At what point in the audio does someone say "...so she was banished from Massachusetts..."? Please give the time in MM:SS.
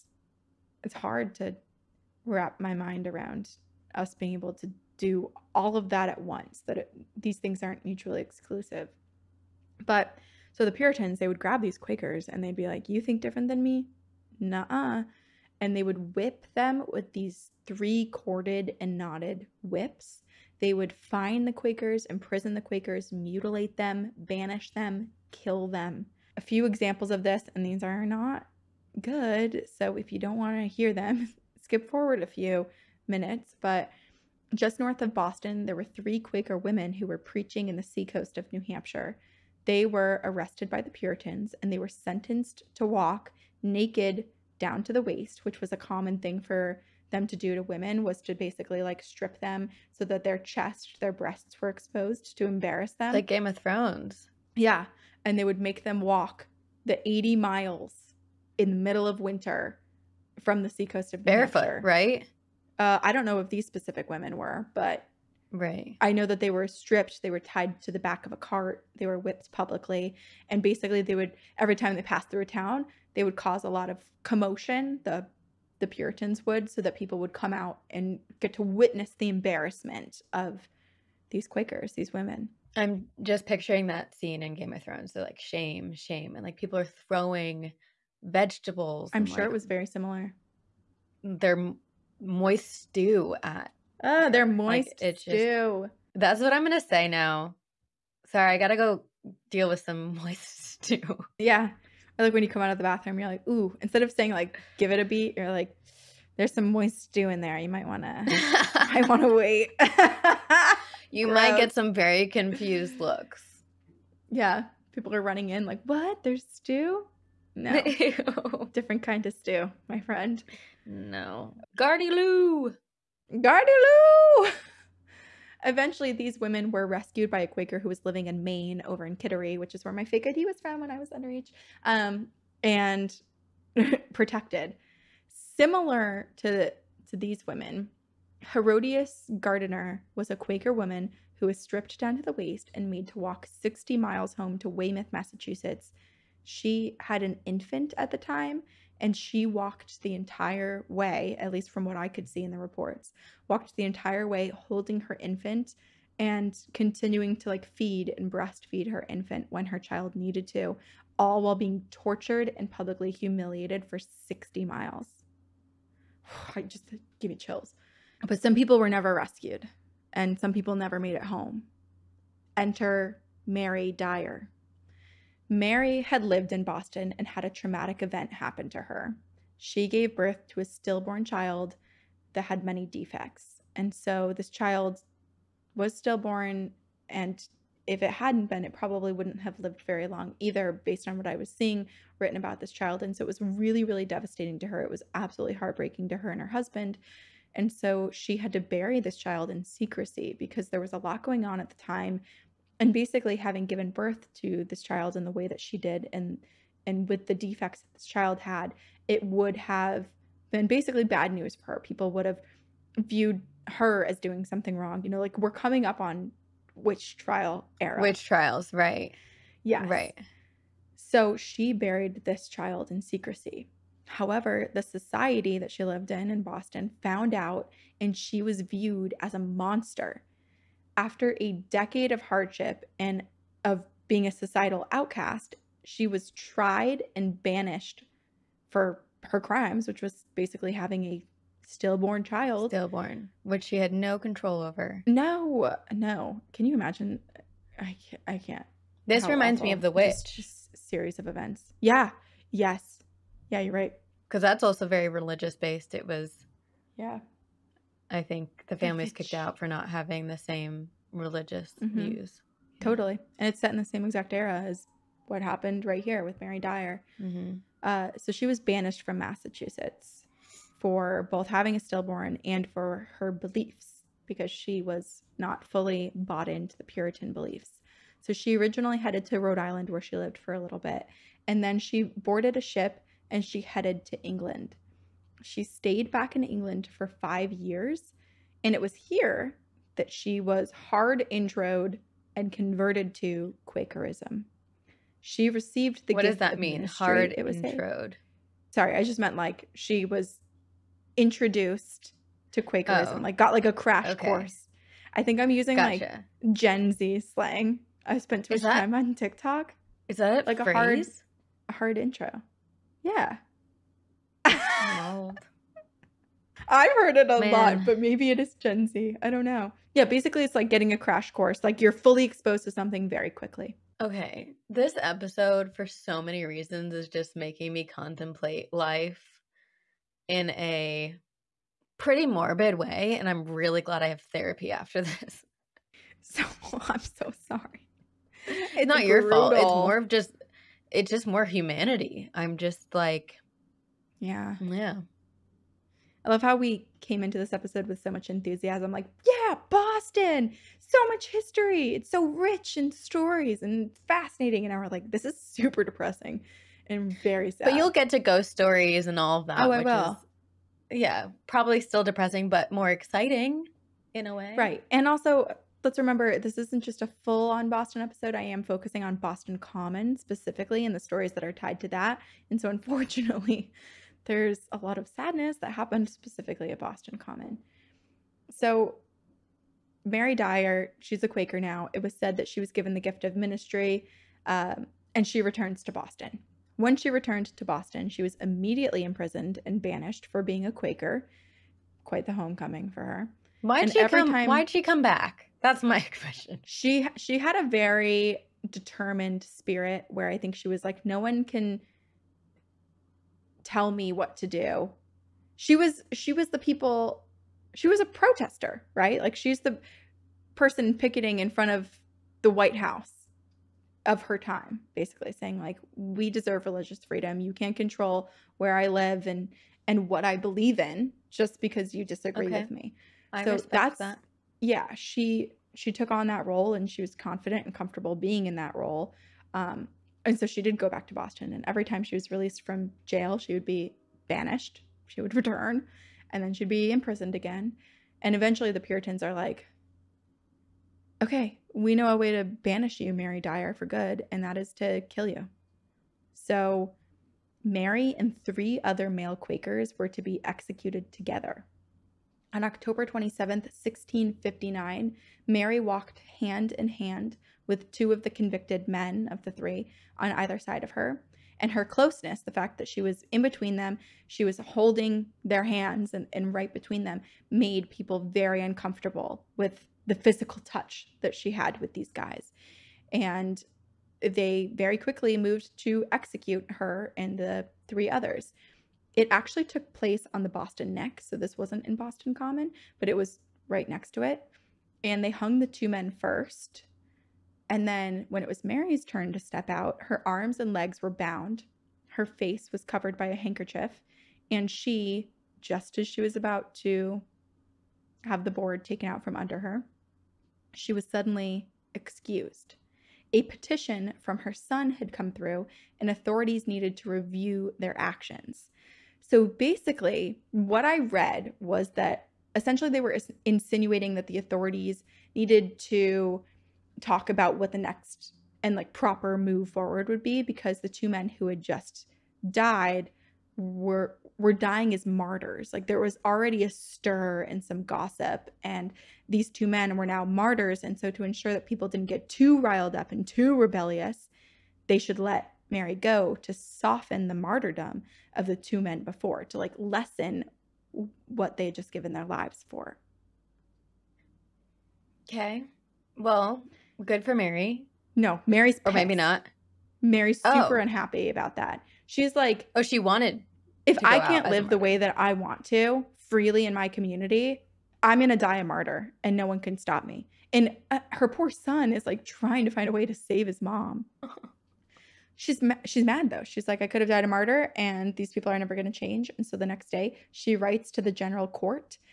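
04:28.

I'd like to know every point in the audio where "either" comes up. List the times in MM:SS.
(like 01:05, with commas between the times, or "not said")
03:10, 07:40.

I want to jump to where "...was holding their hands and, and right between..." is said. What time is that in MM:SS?
07:44.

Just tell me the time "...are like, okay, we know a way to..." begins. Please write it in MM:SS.
07:19.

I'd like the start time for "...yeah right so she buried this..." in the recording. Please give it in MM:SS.
03:39.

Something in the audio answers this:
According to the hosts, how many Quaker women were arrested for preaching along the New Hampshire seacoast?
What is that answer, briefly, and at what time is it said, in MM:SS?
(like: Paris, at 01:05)
3, at 00:35.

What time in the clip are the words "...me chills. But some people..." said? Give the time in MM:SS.
02:47.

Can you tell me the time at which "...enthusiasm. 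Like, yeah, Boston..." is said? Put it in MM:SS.
05:48.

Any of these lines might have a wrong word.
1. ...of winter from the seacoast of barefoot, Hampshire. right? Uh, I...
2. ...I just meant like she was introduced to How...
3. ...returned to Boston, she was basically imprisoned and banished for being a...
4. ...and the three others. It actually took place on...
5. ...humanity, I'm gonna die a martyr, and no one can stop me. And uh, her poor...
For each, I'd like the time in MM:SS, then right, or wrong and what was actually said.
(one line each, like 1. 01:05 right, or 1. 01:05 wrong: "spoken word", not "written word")
1. 00:59 right
2. 04:58 wrong: "Quakerism", not "How"
3. 06:27 wrong: "immediately", not "basically"
4. 07:57 right
5. 09:16 wrong: "community", not "humanity".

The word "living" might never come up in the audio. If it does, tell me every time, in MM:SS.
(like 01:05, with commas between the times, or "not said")
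02:08.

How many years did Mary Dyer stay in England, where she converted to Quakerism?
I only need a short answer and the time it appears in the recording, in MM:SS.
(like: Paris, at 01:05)
5, at 04:47.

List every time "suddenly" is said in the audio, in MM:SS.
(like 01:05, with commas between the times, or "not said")
08:21.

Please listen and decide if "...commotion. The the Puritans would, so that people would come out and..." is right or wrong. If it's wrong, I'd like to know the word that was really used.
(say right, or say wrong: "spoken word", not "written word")
right.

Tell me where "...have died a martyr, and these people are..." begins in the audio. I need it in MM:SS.
09:27.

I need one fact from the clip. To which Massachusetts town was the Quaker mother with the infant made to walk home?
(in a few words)
Weymouth.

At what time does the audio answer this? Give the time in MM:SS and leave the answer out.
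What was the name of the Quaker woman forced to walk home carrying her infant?
02:18.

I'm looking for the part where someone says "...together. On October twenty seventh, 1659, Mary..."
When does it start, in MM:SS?
07:31.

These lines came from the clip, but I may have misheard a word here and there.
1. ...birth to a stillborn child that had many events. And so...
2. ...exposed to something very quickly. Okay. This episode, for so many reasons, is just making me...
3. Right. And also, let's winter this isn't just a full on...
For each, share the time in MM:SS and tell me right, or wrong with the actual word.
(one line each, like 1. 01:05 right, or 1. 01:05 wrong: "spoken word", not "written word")
1. 03:00 wrong: "defects", not "events"
2. 05:22 right
3. 06:04 wrong: "remember", not "winter".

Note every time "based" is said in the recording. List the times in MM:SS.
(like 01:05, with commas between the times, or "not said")
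03:10, 04:15.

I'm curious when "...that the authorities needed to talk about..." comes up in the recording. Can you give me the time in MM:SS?
08:34.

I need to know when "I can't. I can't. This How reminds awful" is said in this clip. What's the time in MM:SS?
04:07.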